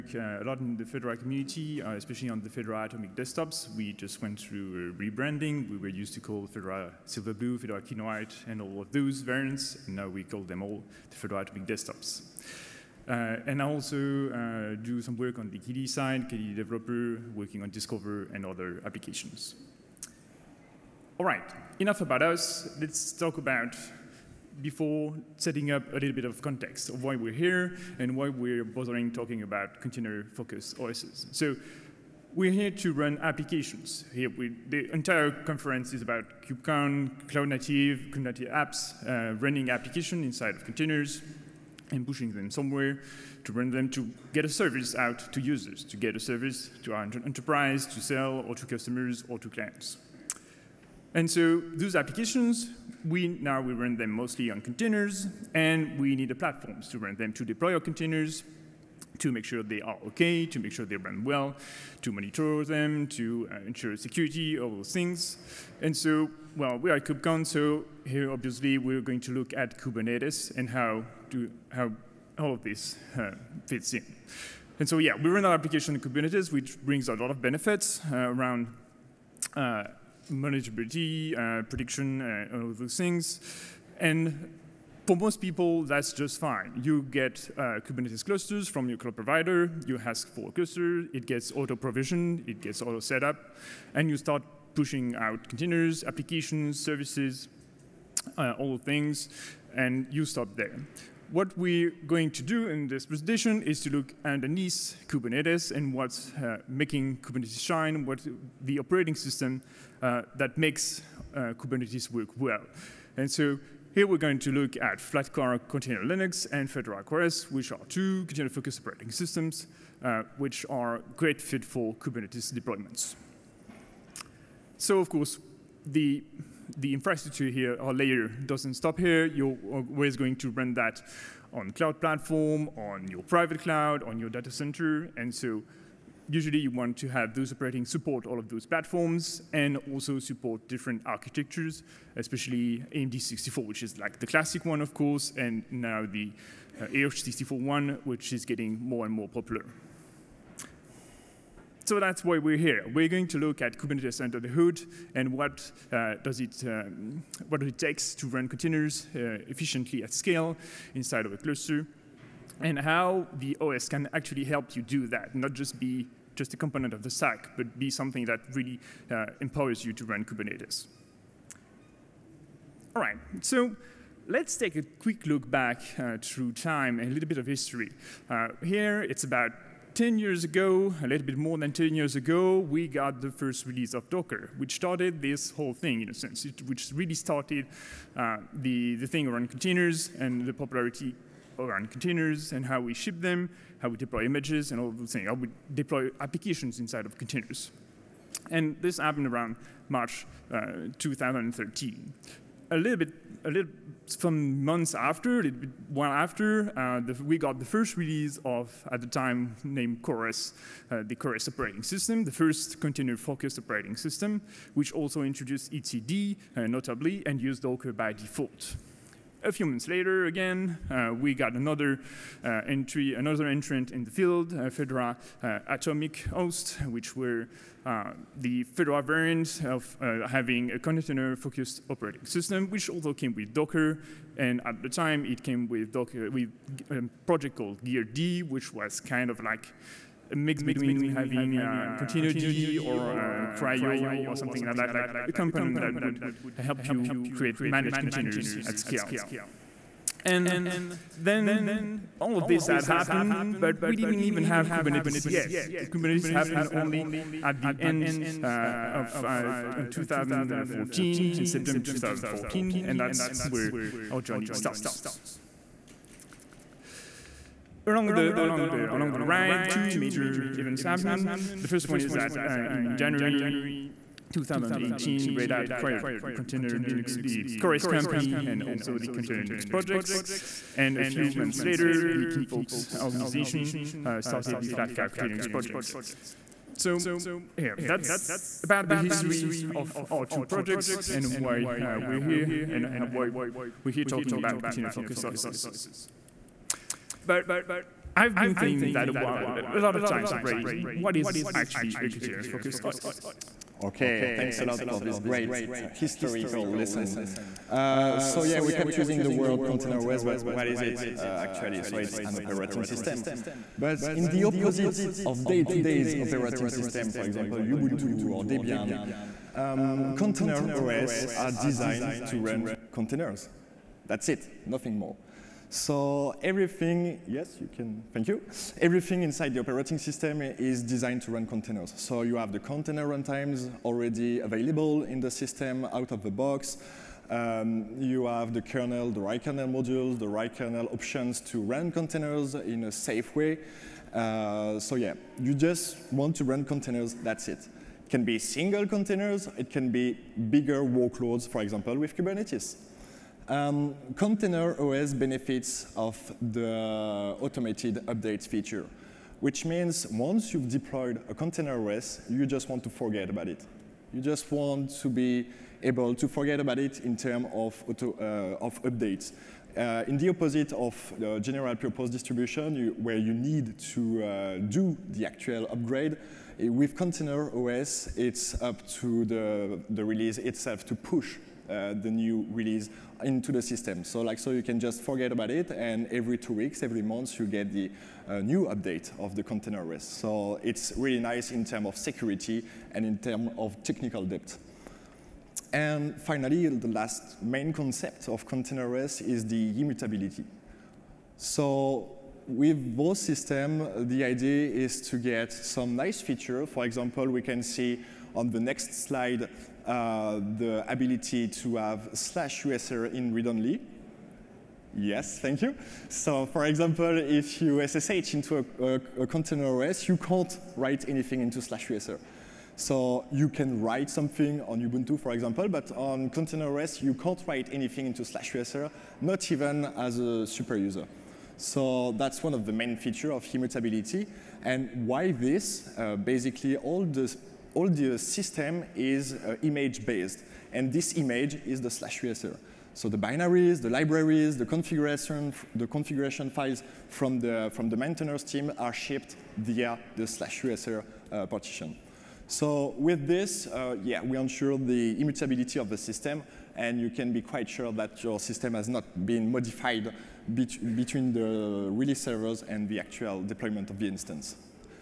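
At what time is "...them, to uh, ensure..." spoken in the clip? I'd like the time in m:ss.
1:02.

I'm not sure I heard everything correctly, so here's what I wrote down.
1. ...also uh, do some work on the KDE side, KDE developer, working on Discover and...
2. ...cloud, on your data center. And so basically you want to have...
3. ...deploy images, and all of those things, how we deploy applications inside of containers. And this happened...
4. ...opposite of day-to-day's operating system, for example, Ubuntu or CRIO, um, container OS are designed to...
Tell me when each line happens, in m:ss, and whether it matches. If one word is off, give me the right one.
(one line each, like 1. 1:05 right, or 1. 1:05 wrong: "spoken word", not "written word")
1. 0:13 right
2. 2:13 wrong: "usually", not "basically"
3. 3:13 right
4. 5:14 wrong: "Debian", not "CRIO".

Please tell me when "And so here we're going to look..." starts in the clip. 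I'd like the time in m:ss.
1:53.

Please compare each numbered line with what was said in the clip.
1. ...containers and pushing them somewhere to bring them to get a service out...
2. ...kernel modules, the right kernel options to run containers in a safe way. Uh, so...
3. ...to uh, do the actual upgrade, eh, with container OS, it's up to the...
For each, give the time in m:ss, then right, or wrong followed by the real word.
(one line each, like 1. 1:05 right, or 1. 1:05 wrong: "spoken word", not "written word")
1. 0:40 right
2. 5:39 right
3. 6:13 right.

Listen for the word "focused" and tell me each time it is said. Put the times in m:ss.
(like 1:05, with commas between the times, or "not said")
0:29, 1:58, 3:32, 3:50, 4:54, 5:02.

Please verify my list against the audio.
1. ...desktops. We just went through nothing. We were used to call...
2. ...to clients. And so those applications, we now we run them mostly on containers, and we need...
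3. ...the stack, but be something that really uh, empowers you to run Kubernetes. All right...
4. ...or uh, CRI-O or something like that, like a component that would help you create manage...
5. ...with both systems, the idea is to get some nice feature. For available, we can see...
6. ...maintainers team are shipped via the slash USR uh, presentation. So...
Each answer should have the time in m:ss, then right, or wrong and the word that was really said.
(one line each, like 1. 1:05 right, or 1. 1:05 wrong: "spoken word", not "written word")
1. 0:03 wrong: "rebranding", not "nothing"
2. 0:49 right
3. 2:47 right
4. 4:02 right
5. 6:42 wrong: "example", not "available"
6. 7:27 wrong: "partition", not "presentation".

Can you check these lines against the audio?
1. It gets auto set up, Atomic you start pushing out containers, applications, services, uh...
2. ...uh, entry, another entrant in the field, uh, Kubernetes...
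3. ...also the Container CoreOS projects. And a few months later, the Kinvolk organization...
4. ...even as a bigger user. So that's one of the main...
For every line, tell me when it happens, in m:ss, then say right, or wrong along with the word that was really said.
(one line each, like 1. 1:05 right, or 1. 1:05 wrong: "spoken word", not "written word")
1. 1:32 wrong: "And", not "Atomic"
2. 3:42 wrong: "Fedora", not "Kubernetes"
3. 4:38 wrong: "Linux", not "CoreOS"
4. 7:09 wrong: "super", not "bigger".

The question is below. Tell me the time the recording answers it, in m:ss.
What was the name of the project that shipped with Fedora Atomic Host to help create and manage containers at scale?
3:57.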